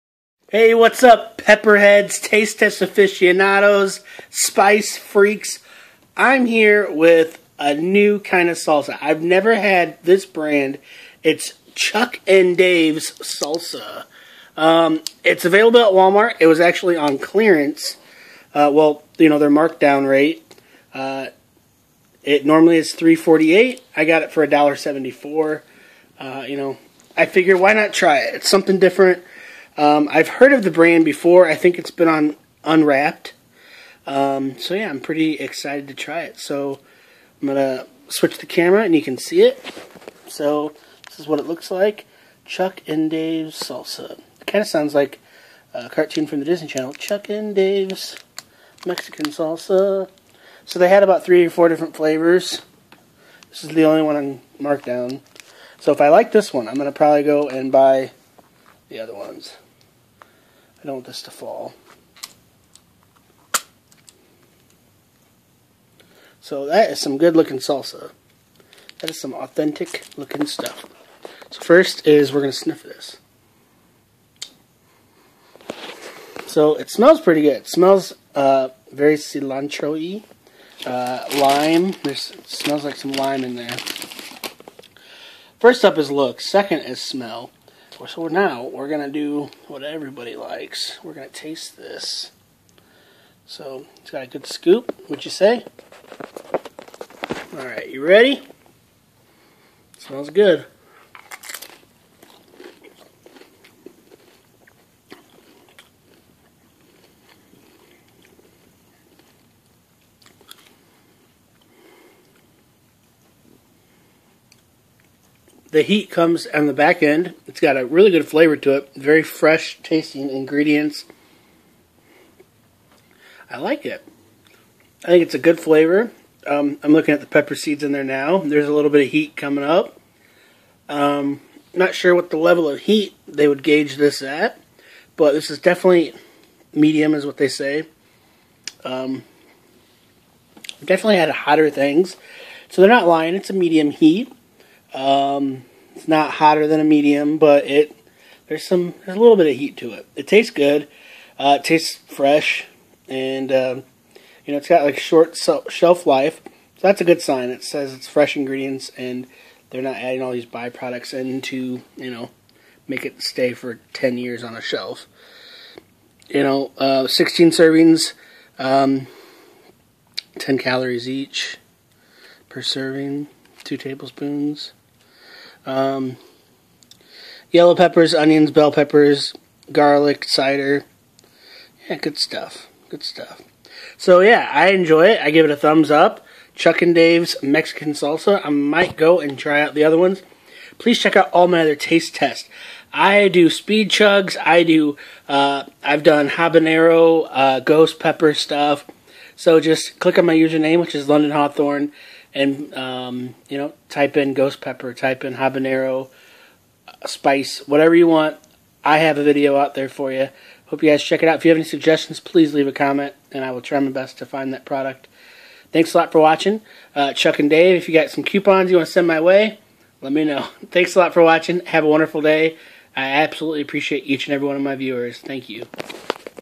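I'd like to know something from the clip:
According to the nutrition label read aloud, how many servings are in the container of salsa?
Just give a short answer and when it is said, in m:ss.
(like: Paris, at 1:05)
16, at 2:47.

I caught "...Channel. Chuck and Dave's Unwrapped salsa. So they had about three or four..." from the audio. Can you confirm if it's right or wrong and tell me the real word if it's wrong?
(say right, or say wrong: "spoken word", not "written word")
wrong: "Mexican", not "Unwrapped".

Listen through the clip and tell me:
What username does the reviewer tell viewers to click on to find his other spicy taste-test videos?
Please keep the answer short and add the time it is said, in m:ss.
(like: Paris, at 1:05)
London Hawthorne, at 3:21.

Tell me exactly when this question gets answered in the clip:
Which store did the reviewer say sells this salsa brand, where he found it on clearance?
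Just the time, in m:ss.
0:15.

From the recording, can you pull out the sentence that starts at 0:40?
So this is what it looks like.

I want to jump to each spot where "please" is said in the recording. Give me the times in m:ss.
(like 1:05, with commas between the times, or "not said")
3:10, 3:32.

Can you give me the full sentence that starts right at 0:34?
Um, so yeah, I'm pretty excited to try it.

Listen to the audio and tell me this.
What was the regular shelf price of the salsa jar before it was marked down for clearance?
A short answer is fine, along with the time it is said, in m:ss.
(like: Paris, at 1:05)
$3.48, at 0:22.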